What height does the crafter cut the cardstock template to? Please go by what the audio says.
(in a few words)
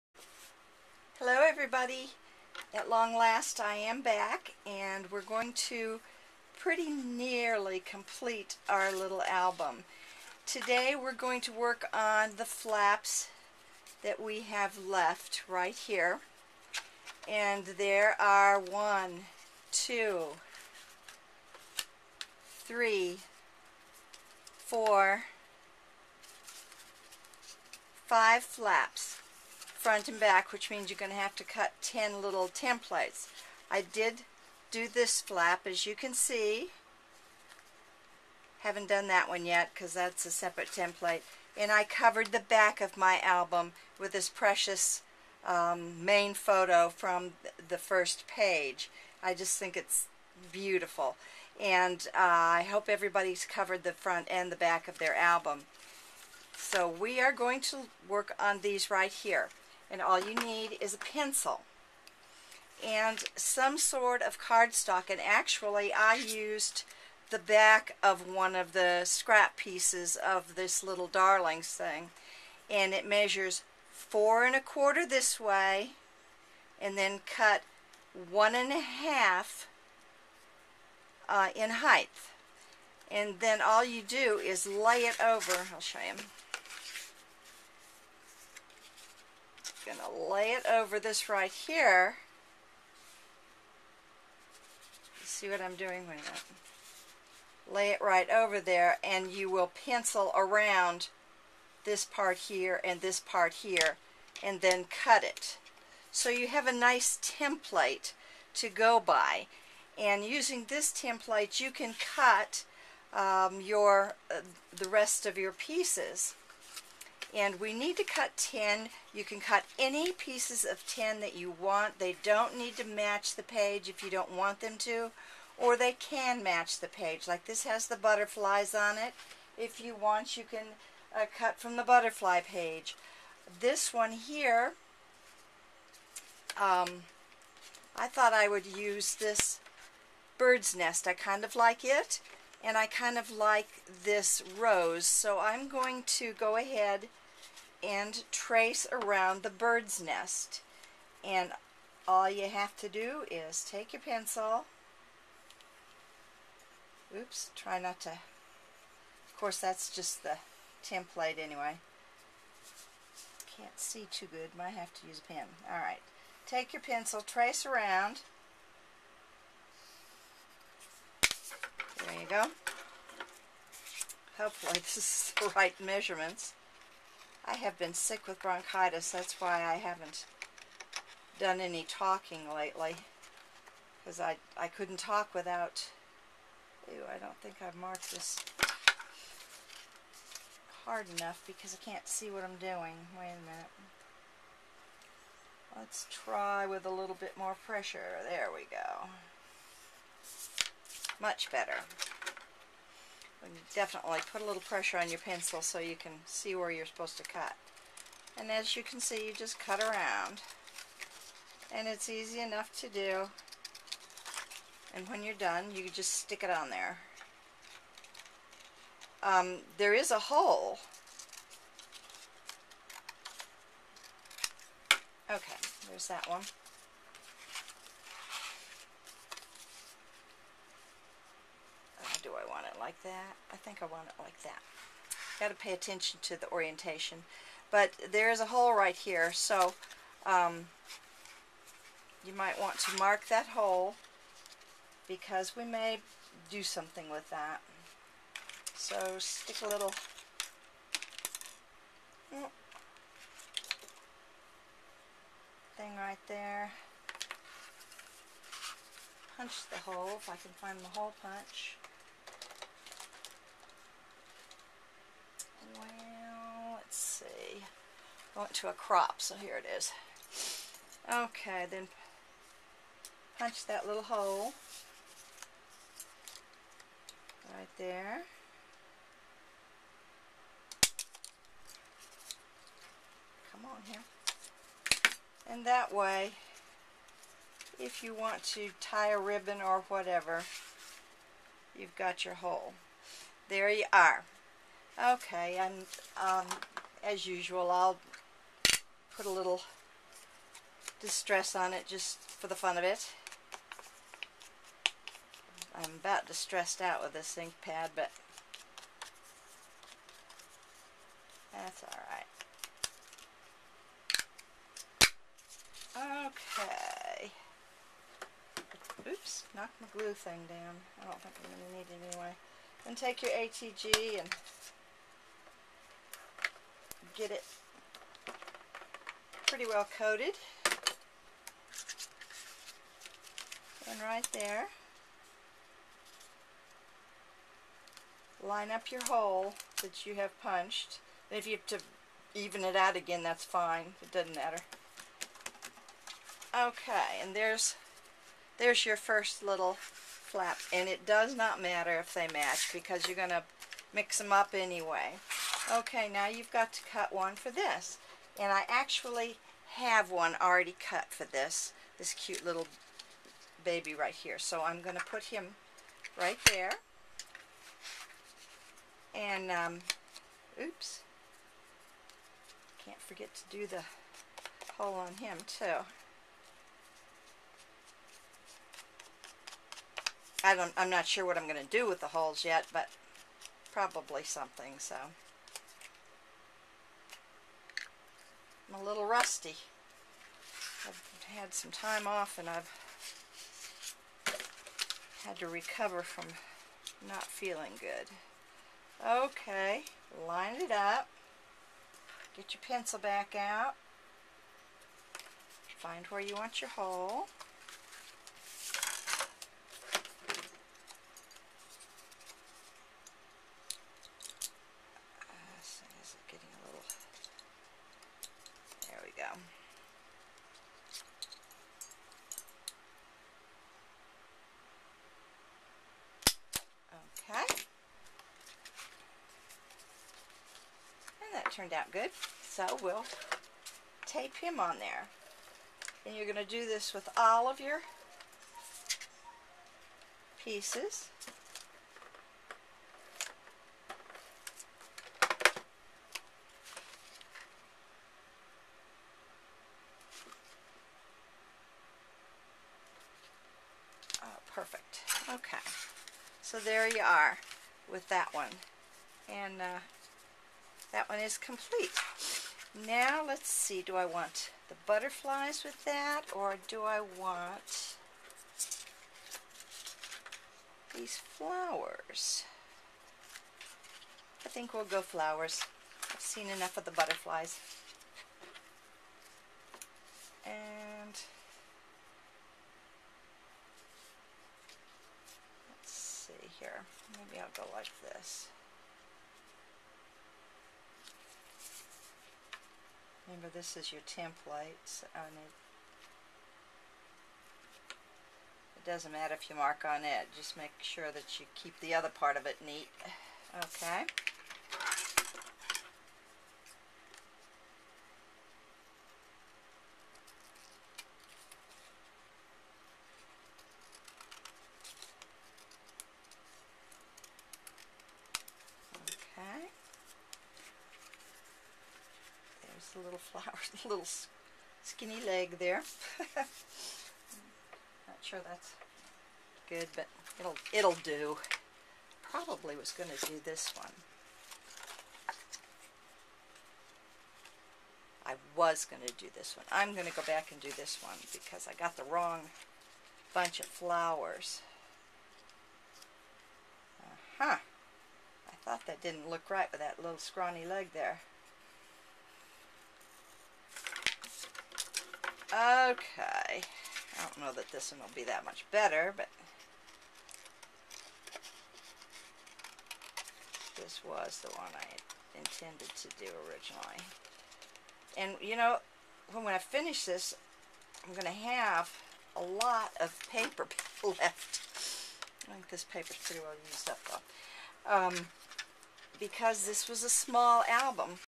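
1 1/2.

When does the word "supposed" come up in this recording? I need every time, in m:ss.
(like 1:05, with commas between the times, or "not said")
3:26.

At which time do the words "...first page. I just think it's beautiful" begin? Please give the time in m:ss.
0:47.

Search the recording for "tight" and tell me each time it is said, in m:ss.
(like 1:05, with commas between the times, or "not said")
not said.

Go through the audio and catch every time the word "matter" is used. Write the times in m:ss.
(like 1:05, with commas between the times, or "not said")
5:44, 5:51, 8:19.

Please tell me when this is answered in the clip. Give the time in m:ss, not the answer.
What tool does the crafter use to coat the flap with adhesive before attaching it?
5:23.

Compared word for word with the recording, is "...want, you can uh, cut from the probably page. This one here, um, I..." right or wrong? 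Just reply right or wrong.
wrong.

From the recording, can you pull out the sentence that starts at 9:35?
I think this paper's pretty well used up, though.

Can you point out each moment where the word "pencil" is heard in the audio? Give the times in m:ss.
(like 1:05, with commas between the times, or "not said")
1:00, 1:39, 2:34, 2:46, 3:25, 6:42.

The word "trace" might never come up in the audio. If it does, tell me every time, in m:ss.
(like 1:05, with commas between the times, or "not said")
2:28, 2:47.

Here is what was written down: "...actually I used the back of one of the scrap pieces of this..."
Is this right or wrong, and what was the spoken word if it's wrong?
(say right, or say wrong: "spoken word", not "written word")
right.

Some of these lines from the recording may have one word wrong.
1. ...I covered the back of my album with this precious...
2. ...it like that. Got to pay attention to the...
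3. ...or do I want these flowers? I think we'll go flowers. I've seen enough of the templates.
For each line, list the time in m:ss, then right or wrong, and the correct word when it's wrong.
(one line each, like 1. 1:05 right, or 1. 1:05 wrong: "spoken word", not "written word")
1. 0:41 right
2. 3:54 right
3. 7:46 wrong: "butterflies", not "templates".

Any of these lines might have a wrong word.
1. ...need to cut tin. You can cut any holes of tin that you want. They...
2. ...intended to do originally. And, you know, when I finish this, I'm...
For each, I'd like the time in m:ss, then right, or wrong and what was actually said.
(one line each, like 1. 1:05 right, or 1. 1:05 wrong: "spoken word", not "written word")
1. 1:57 wrong: "pieces", not "holes"
2. 9:25 right.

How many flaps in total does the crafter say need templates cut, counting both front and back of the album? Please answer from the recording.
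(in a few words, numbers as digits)
10.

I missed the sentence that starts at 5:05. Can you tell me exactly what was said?
I'm about distressed out with this ink pad, but that's alright.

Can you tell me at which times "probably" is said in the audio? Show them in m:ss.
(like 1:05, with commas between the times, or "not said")
6:23, 8:52.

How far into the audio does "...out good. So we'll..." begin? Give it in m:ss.
7:11.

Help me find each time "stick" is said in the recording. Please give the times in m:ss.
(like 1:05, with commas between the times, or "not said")
3:36, 4:09.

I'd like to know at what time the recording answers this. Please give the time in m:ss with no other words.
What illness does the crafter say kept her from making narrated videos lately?
2:58.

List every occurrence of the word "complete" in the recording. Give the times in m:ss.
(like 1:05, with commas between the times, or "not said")
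0:07, 7:41.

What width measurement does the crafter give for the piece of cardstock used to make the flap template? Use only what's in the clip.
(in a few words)
4 1/4.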